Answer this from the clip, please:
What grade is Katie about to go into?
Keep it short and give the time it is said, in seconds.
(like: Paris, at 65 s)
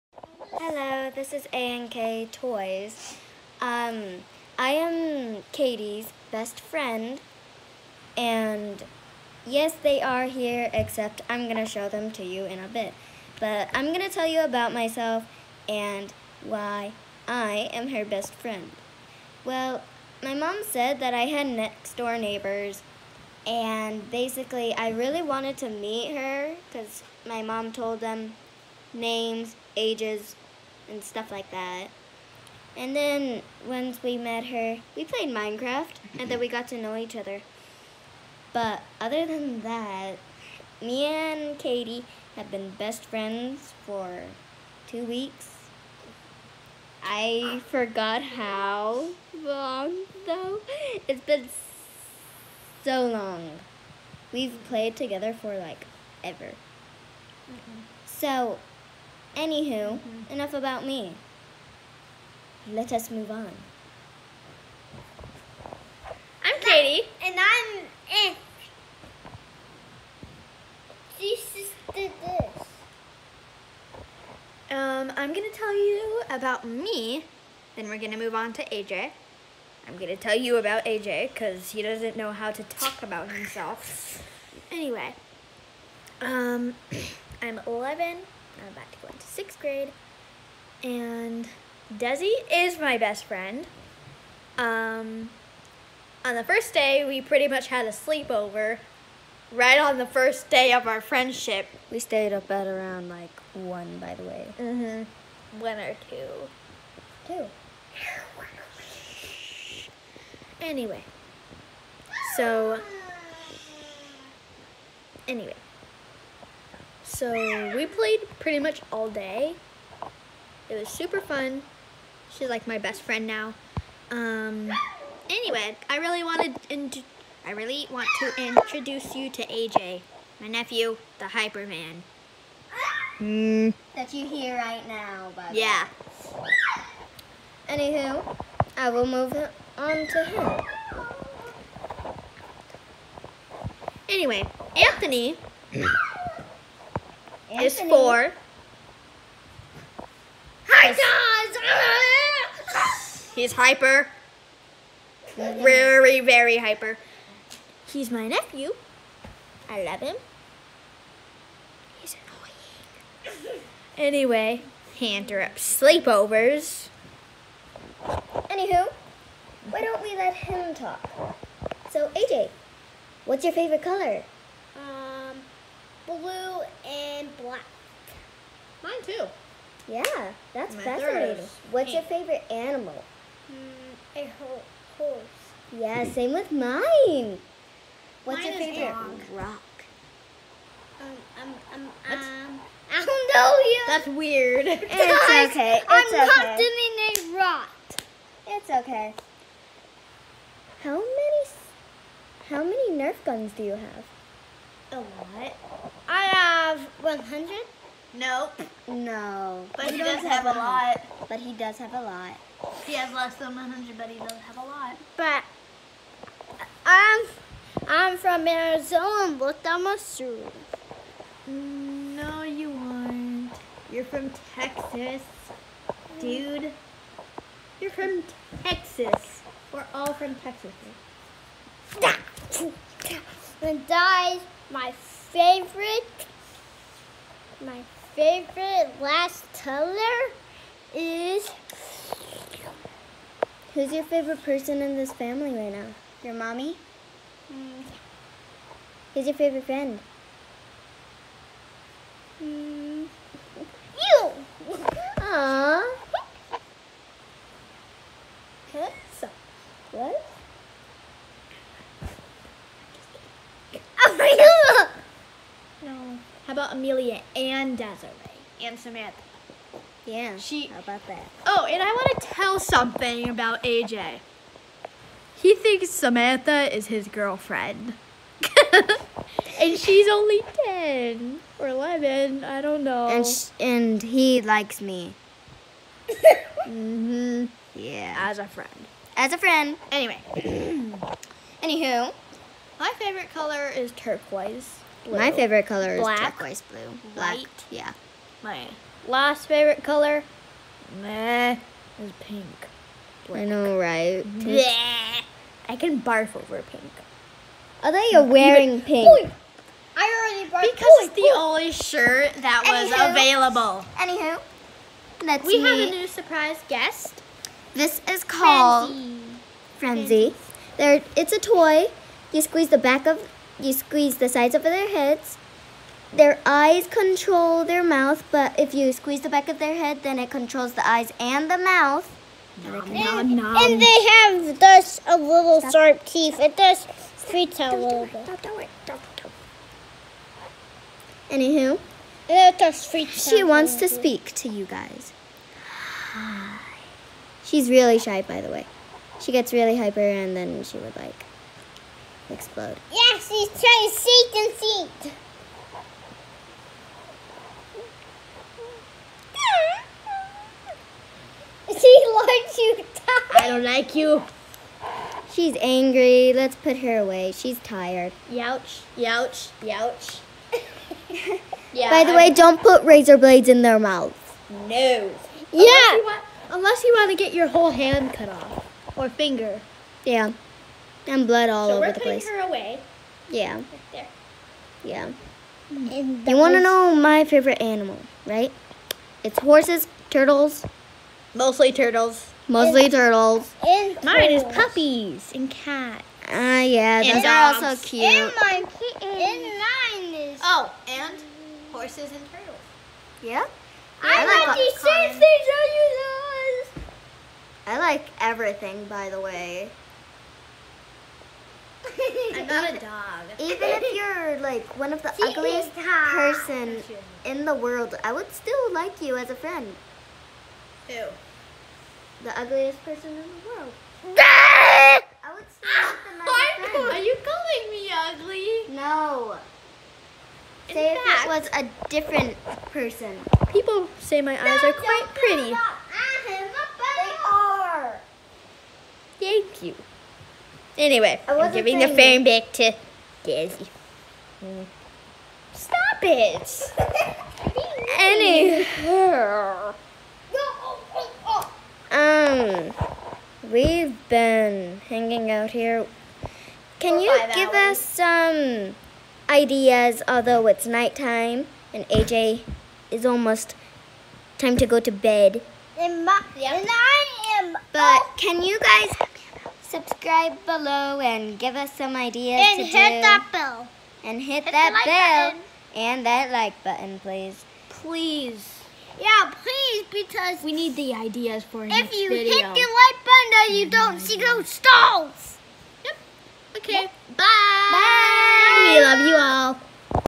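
sixth grade, at 89 s.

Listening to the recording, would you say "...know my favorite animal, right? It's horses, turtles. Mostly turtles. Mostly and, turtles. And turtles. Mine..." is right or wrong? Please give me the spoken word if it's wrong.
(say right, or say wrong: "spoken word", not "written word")
right.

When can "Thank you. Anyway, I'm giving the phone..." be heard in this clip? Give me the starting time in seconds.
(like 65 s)
439 s.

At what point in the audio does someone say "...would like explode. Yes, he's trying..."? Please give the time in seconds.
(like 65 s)
350 s.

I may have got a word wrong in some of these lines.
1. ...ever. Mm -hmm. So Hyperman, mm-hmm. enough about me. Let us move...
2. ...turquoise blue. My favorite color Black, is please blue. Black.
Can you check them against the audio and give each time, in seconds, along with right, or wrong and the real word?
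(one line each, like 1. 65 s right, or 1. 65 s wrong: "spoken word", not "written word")
1. 56 s wrong: "Anywho", not "Hyperman"
2. 293 s wrong: "turquoise", not "please".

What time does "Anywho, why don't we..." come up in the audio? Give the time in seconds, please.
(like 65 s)
168 s.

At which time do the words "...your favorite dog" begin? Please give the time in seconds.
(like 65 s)
188 s.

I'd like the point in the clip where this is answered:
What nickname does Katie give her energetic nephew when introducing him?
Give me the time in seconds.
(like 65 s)
131 s.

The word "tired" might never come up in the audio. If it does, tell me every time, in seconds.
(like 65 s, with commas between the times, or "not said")
362 s, 367 s.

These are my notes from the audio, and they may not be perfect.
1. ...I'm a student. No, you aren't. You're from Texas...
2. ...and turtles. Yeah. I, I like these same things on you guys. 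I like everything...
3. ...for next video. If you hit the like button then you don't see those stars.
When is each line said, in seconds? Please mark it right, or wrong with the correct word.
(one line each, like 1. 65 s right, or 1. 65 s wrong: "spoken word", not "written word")
1. 219 s right
2. 402 s right
3. 481 s right.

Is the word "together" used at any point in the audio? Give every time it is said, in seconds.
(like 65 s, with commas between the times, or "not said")
54 s.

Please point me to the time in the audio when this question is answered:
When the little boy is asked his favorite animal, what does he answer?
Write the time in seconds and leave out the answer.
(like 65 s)
184 s.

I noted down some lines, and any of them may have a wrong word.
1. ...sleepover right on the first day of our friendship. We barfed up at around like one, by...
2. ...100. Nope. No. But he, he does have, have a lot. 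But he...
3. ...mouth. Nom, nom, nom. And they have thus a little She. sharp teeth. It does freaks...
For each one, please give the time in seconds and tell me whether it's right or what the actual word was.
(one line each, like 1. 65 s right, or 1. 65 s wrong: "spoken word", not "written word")
1. 97 s wrong: "stayed", not "barfed"
2. 207 s right
3. 331 s wrong: "Stop", not "She".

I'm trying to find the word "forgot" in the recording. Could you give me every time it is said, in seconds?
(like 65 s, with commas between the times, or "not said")
47 s.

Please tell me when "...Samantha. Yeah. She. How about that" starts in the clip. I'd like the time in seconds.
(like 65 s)
268 s.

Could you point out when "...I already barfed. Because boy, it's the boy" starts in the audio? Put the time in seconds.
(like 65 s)
309 s.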